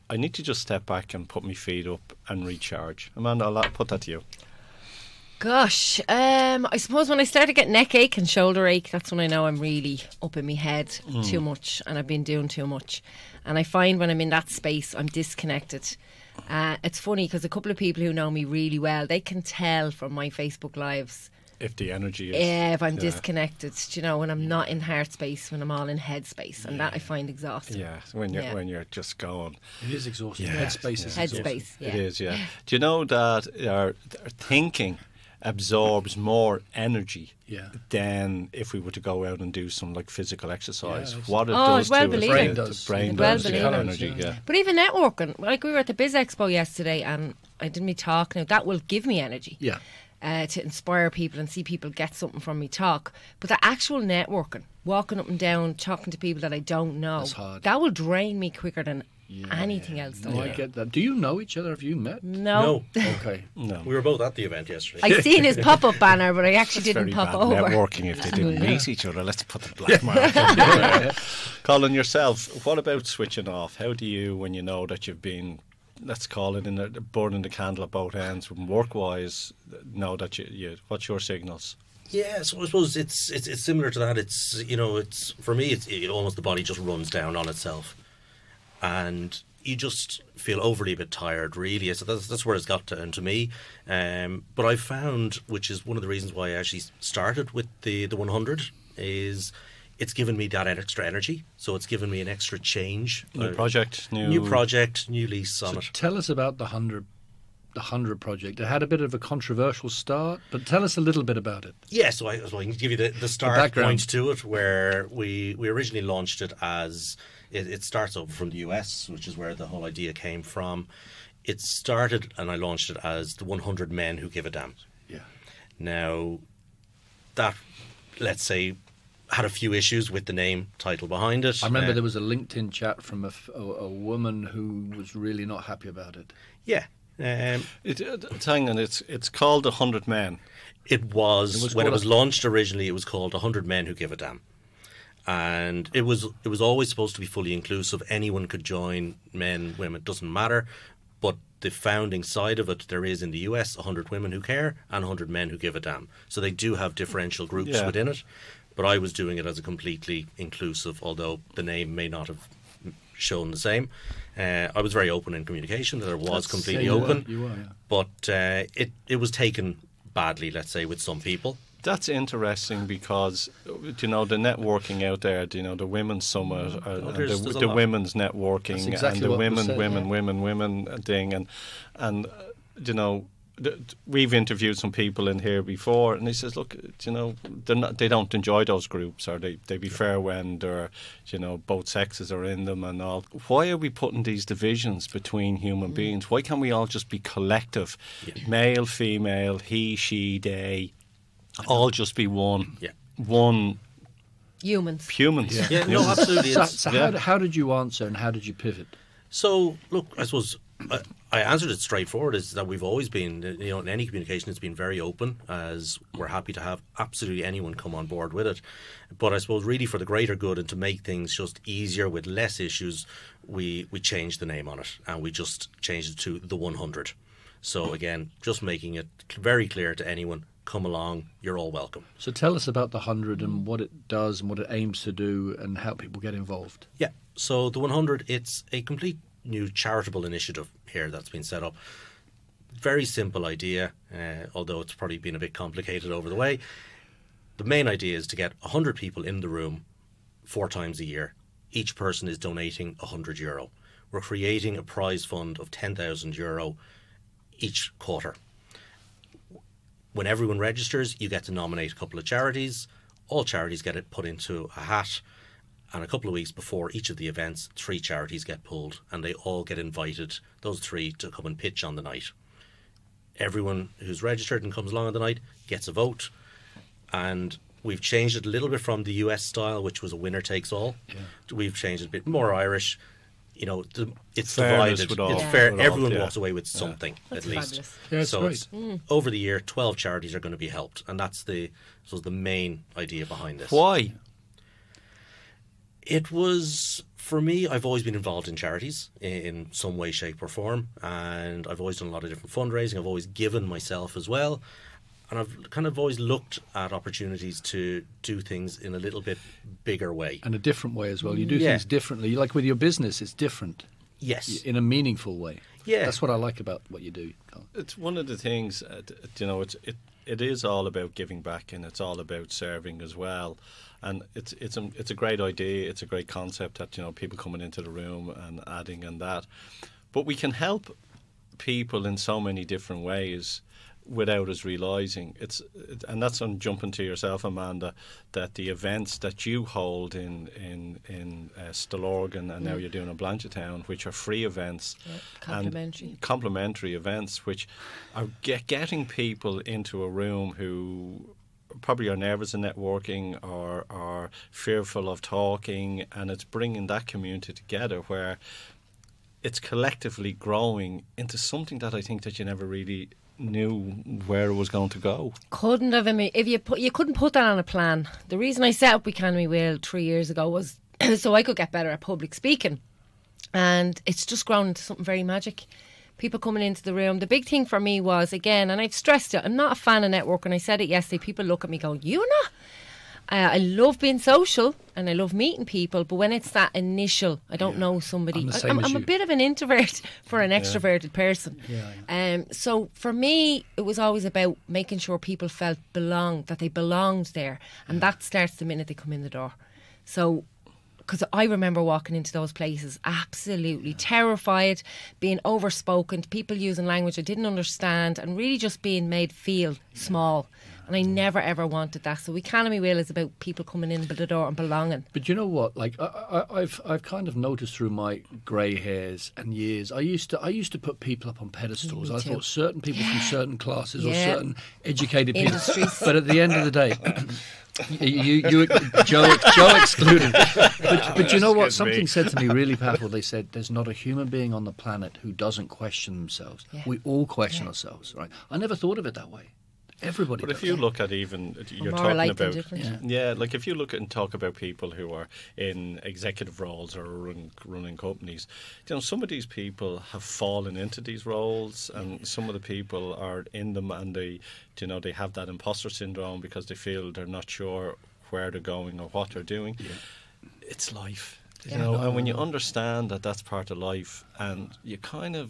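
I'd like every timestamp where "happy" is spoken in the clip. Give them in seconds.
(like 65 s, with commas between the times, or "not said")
135 s, 216 s.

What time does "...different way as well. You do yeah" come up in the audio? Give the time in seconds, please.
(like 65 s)
310 s.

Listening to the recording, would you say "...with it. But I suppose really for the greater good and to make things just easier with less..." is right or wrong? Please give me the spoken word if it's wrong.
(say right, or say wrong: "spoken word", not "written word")
right.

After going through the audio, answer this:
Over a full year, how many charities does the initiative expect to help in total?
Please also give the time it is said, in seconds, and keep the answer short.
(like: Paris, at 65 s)
12, at 289 s.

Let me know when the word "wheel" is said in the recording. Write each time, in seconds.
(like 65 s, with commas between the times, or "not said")
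369 s, 412 s.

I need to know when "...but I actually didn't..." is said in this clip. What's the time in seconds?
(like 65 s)
66 s.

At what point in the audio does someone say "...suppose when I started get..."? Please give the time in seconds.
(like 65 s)
6 s.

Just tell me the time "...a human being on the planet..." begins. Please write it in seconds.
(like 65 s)
433 s.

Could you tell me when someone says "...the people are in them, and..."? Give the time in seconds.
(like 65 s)
452 s.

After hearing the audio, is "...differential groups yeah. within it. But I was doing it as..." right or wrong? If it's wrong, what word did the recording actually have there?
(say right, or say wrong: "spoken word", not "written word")
right.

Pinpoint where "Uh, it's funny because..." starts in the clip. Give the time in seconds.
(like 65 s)
16 s.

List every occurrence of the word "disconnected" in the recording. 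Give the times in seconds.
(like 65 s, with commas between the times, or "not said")
15 s, 22 s.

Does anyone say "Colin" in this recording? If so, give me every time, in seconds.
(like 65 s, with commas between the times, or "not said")
71 s, 317 s.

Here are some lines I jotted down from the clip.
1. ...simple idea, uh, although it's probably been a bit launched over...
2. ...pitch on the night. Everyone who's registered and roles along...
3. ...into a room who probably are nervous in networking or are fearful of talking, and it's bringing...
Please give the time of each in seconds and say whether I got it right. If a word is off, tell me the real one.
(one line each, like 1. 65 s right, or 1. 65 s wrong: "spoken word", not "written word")
1. 243 s wrong: "complicated", not "launched"
2. 271 s wrong: "comes", not "roles"
3. 349 s right.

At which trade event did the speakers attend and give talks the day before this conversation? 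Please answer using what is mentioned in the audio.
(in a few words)
Biz Expo.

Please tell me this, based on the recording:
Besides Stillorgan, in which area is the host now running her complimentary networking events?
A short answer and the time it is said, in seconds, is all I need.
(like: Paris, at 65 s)
Blanchardstown, at 343 s.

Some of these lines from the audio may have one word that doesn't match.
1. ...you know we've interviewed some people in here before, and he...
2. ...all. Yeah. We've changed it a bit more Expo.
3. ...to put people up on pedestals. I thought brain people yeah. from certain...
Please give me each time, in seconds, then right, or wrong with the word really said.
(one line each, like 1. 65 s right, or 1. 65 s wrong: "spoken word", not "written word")
1. 182 s right
2. 280 s wrong: "Irish", not "Expo"
3. 420 s wrong: "certain", not "brain".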